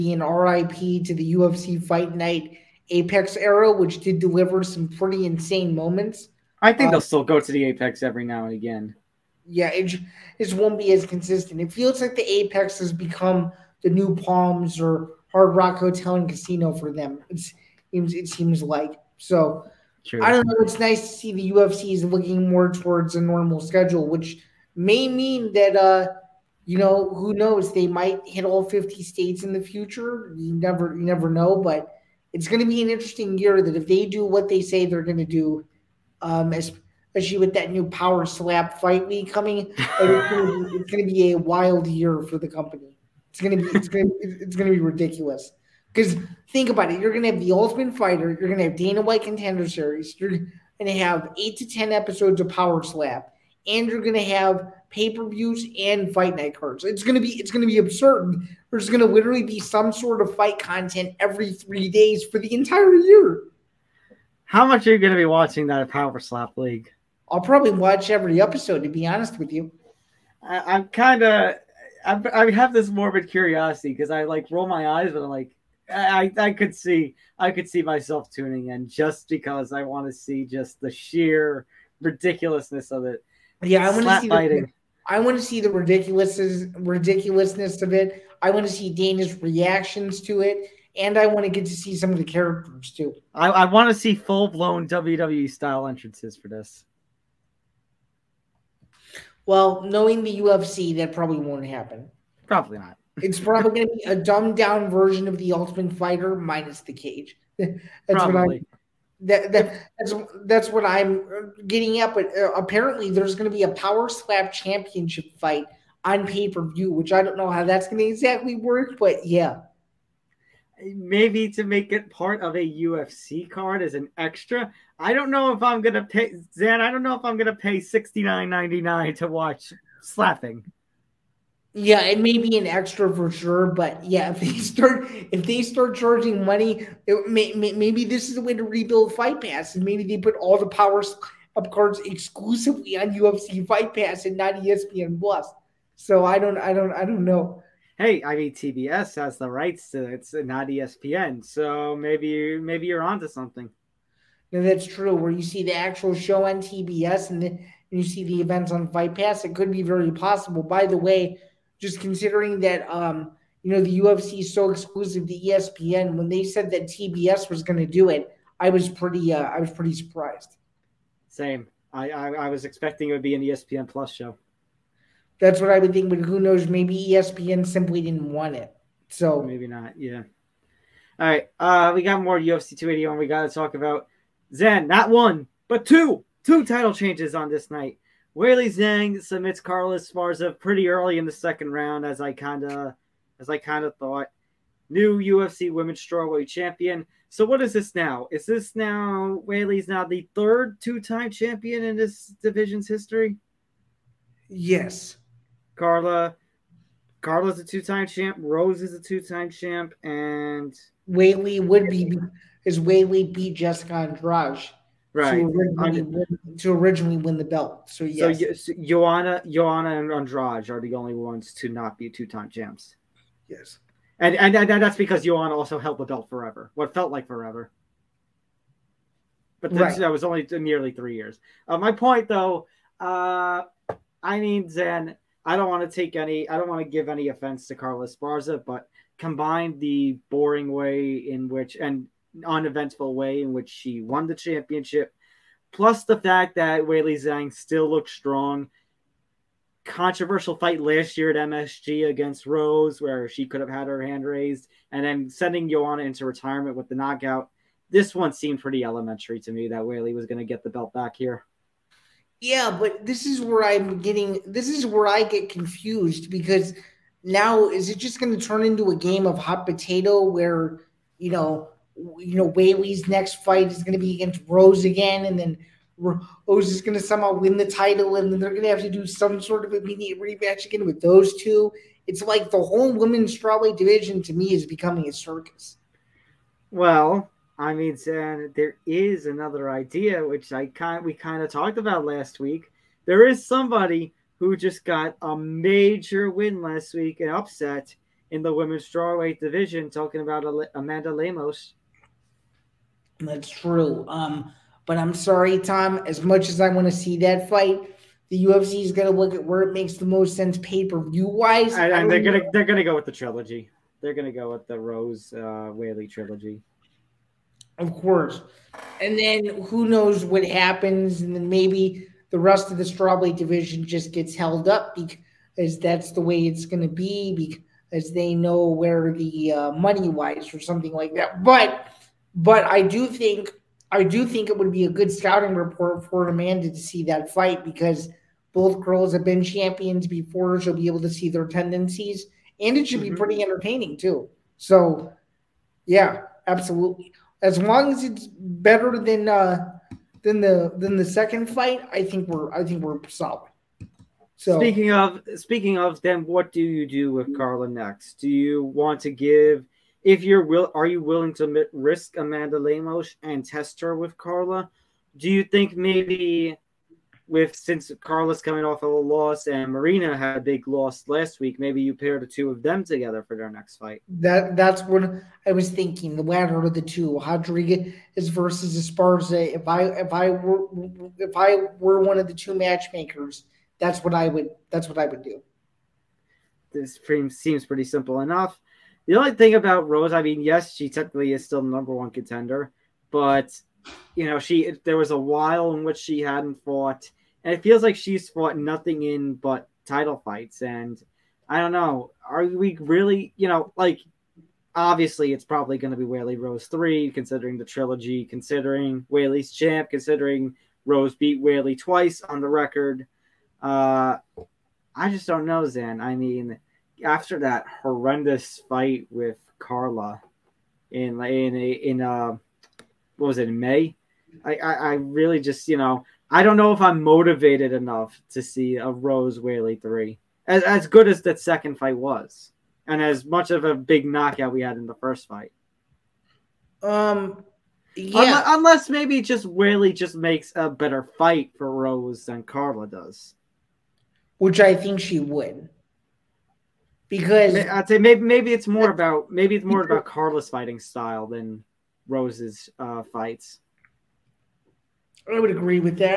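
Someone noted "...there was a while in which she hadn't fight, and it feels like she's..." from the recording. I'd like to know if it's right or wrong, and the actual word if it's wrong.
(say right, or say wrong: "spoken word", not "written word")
wrong: "fought", not "fight".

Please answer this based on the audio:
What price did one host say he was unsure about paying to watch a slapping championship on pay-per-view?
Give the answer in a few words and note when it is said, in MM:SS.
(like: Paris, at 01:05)
$69.99, at 02:07.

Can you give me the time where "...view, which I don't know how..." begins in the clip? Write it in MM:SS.
01:56.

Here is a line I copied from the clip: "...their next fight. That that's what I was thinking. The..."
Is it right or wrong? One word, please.
right.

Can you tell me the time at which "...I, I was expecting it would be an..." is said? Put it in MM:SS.
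02:52.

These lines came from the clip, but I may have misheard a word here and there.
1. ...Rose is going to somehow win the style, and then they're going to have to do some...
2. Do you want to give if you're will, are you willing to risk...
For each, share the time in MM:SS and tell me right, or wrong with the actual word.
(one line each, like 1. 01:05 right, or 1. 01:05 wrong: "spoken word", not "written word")
1. 04:35 wrong: "title", not "style"
2. 05:58 right.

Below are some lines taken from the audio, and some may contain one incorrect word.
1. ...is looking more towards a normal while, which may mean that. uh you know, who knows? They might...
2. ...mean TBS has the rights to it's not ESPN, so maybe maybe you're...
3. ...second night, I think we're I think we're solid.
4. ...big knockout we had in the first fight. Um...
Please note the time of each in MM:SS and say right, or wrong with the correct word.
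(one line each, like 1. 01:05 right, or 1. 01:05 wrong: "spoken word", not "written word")
1. 00:21 wrong: "schedule", not "while"
2. 02:28 right
3. 05:51 wrong: "fight", not "night"
4. 07:13 right.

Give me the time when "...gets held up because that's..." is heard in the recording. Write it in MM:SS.
05:24.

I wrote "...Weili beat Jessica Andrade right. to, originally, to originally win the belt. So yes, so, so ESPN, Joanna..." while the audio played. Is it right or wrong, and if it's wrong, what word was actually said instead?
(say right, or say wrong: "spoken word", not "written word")
wrong: "Joanna", not "ESPN".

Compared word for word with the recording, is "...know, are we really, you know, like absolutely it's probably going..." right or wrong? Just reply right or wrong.
wrong.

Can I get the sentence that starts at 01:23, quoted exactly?
Yeah, I want to see fighting.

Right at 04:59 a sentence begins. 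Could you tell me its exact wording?
Talking about Amanda Lemos that's true.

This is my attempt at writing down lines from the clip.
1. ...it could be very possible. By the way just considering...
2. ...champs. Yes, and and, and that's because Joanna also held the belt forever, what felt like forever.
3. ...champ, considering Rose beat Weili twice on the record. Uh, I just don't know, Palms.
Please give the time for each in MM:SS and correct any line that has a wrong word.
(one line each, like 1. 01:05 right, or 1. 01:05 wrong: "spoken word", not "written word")
1. 02:39 right
2. 03:42 right
3. 06:49 wrong: "Zain", not "Palms".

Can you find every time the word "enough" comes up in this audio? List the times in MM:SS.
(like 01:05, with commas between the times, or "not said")
06:28, 07:07.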